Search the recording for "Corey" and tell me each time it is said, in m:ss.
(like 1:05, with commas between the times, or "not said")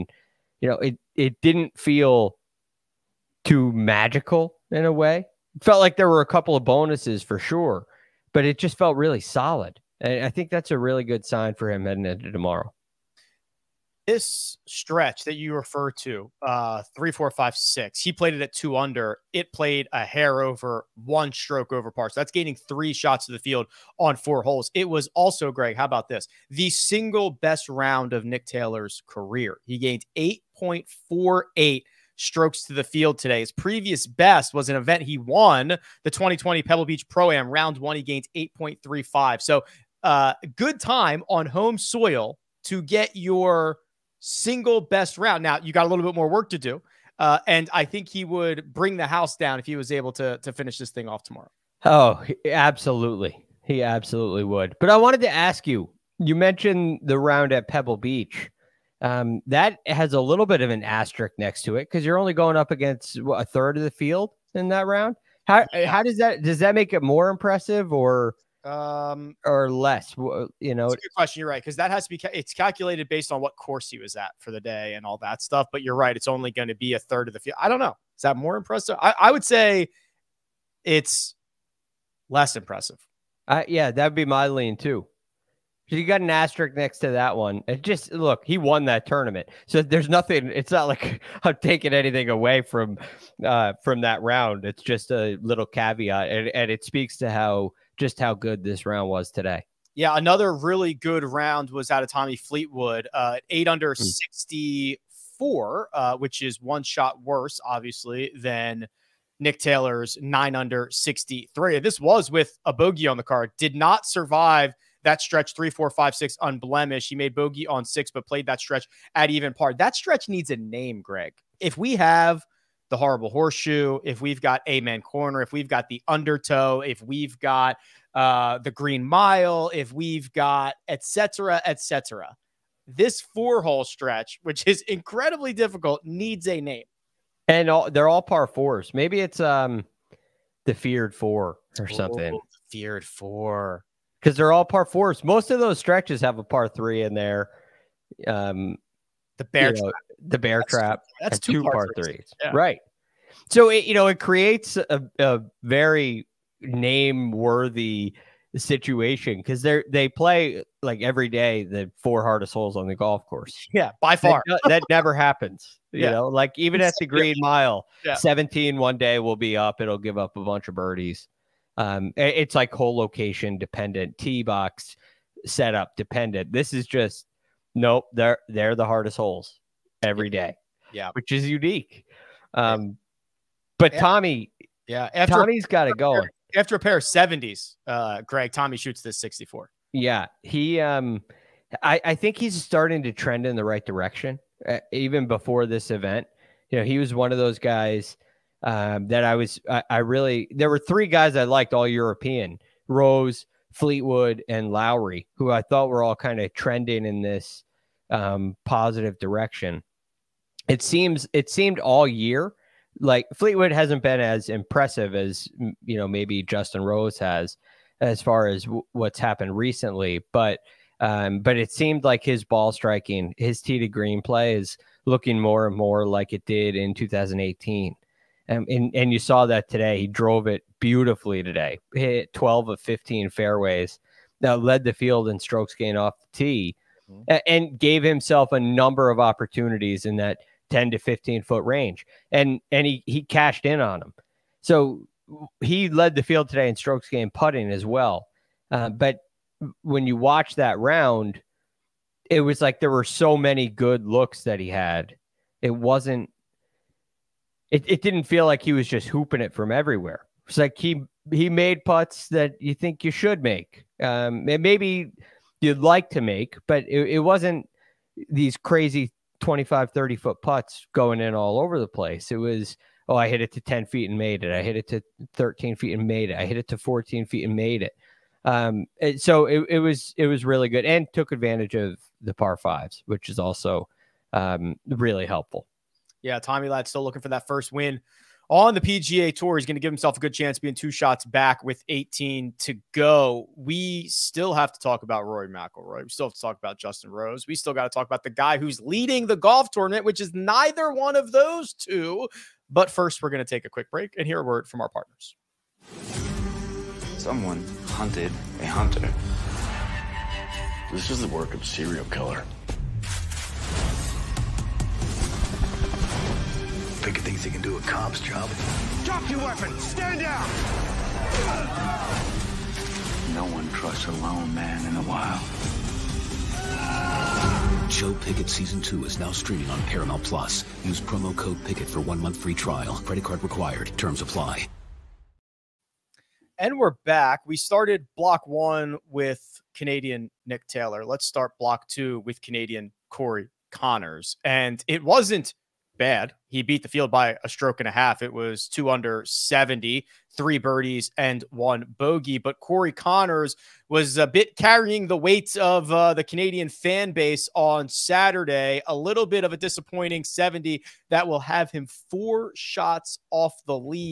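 5:43, 5:52.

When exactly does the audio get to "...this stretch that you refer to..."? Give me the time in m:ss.
0:14.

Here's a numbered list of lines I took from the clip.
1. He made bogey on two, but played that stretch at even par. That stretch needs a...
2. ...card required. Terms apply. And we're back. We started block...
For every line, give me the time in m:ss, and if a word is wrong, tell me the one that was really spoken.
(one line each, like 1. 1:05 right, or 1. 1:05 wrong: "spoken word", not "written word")
1. 1:57 wrong: "six", not "two"
2. 5:33 right.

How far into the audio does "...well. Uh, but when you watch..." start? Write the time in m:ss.
4:07.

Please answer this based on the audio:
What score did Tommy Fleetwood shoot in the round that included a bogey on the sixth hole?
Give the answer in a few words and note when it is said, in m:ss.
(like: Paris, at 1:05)
64, at 1:44.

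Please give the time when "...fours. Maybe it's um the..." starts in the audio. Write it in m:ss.
2:18.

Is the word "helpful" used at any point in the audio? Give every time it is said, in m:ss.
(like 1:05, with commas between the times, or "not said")
4:45.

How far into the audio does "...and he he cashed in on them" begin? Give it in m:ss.
4:02.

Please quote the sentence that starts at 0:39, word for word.
So, uh, good time on home soil to get your single best round.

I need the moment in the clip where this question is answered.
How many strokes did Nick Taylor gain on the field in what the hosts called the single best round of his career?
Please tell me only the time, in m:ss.
0:30.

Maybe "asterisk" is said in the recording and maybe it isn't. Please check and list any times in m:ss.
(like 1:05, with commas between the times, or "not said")
1:00, 1:26.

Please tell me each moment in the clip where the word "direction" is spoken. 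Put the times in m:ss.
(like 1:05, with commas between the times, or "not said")
3:13, 3:29.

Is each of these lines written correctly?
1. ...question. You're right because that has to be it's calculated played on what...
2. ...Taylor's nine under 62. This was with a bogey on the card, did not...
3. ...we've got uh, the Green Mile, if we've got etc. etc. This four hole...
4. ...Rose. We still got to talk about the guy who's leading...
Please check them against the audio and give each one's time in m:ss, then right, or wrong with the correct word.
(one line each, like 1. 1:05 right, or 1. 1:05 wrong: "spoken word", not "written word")
1. 1:11 wrong: "based", not "played"
2. 1:49 wrong: "63", not "62"
3. 2:07 right
4. 4:57 right.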